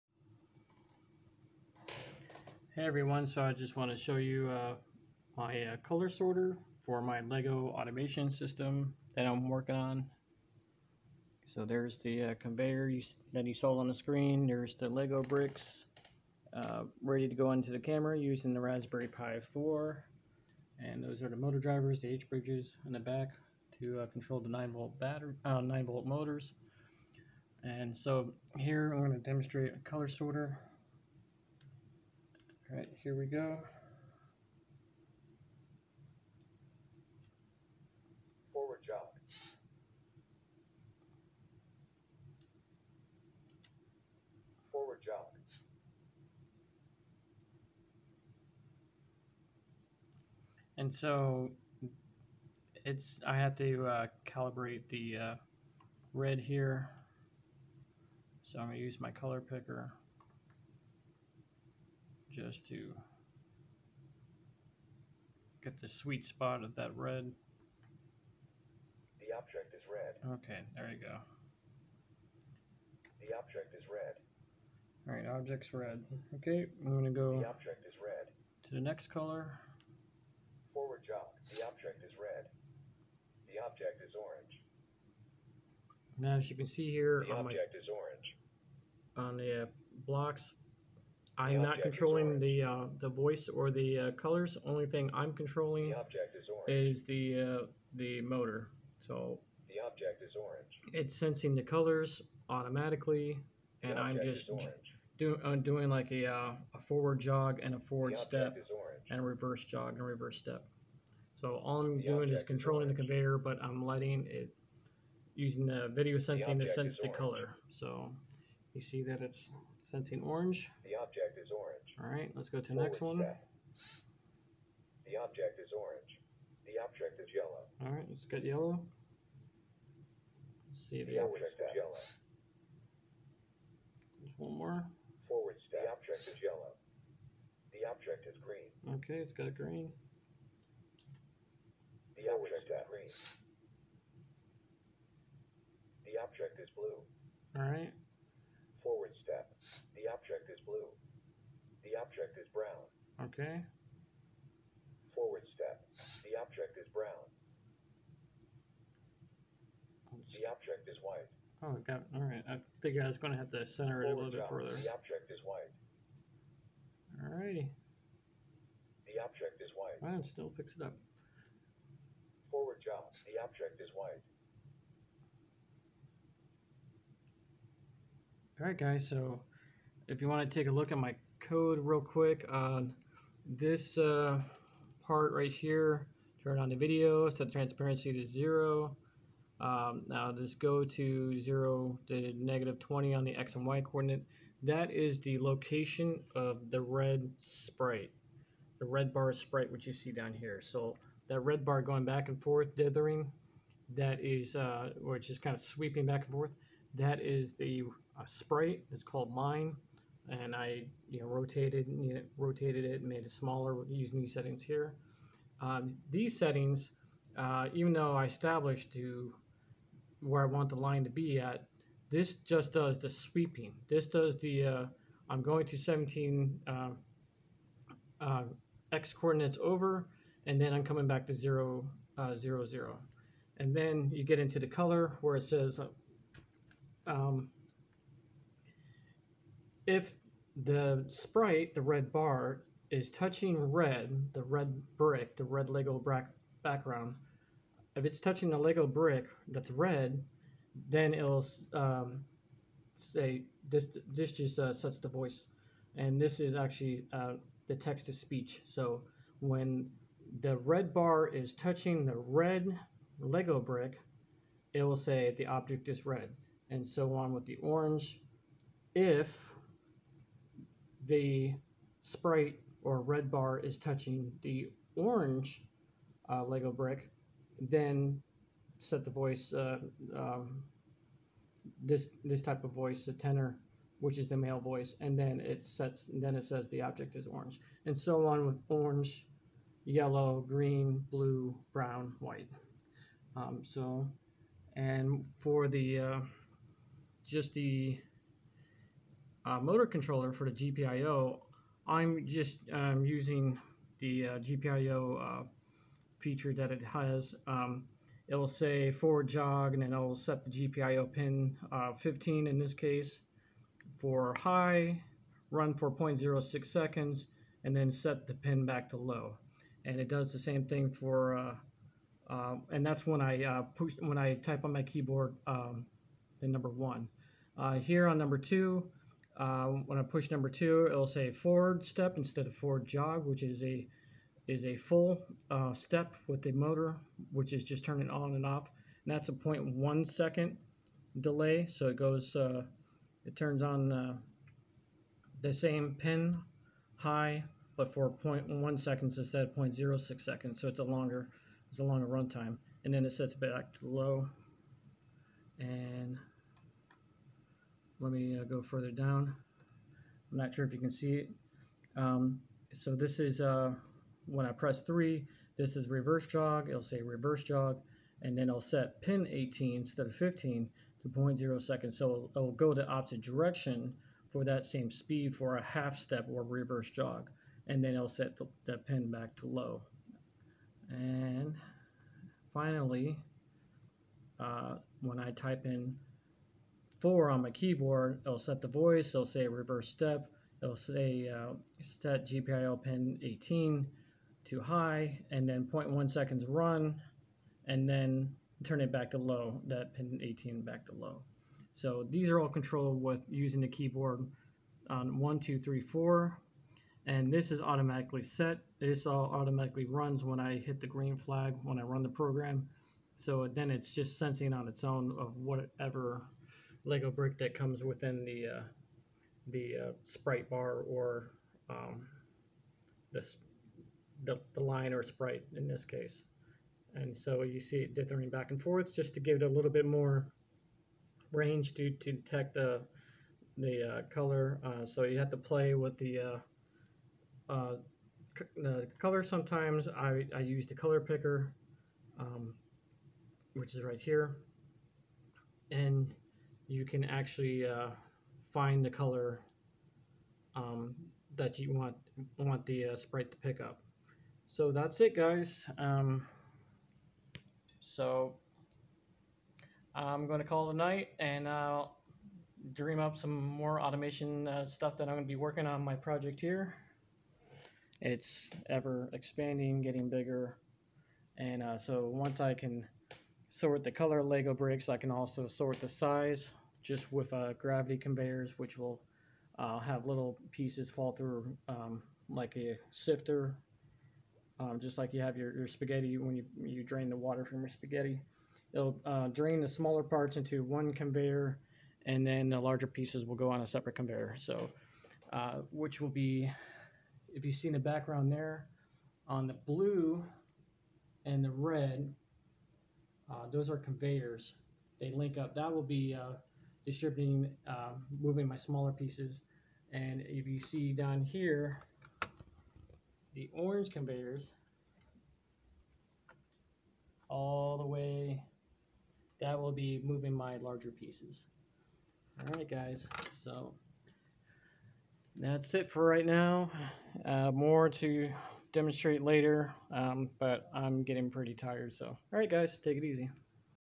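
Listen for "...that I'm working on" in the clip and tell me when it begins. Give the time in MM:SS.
00:09.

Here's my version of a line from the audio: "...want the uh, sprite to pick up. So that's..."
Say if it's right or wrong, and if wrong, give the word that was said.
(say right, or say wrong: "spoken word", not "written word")
right.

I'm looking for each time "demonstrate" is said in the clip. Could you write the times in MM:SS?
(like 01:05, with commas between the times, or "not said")
00:29, 08:48.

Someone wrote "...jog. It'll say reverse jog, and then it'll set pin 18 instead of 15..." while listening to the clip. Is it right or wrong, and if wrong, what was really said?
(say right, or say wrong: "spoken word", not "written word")
right.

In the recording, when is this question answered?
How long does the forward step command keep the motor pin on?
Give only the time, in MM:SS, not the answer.
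05:39.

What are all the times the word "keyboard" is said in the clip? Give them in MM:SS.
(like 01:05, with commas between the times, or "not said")
05:24, 06:27, 06:43.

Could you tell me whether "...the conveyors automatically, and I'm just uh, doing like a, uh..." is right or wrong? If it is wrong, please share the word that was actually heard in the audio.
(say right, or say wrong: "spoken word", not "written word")
wrong: "colors", not "conveyors".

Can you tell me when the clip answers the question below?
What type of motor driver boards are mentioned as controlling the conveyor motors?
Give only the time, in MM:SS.
00:22.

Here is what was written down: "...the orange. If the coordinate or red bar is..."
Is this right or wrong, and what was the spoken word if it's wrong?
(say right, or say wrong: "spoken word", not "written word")
wrong: "sprite", not "coordinate".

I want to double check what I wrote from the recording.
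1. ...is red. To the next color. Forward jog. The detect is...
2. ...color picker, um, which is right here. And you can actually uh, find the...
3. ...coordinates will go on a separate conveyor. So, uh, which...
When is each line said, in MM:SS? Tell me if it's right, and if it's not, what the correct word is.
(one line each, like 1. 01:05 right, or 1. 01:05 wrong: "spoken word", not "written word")
1. 01:17 wrong: "object", not "detect"
2. 07:20 right
3. 08:12 wrong: "pieces", not "coordinates".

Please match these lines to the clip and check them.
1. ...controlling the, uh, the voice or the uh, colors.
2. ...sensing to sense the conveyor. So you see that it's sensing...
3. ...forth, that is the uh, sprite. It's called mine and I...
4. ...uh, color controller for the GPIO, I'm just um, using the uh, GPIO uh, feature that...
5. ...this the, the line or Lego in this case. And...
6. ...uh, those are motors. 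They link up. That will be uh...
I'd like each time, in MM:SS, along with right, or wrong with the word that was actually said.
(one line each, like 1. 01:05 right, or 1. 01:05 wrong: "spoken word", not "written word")
1. 01:31 right
2. 01:56 wrong: "color", not "conveyor"
3. 03:26 right
4. 04:59 wrong: "motor", not "color"
5. 07:03 wrong: "Sprite", not "Lego"
6. 08:23 wrong: "conveyors", not "motors".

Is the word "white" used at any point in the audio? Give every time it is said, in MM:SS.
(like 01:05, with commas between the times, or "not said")
02:41, 02:45, 02:49, 02:53, 04:52.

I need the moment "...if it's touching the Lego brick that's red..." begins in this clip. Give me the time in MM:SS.
04:07.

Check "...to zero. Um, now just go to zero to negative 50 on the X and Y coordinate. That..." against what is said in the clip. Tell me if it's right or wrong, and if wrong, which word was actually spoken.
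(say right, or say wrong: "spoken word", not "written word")
wrong: "20", not "50".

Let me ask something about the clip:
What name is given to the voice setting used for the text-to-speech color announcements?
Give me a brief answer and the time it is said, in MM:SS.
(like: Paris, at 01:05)
tenor, at 04:43.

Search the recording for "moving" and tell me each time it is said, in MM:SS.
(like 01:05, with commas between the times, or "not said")
08:28, 08:40.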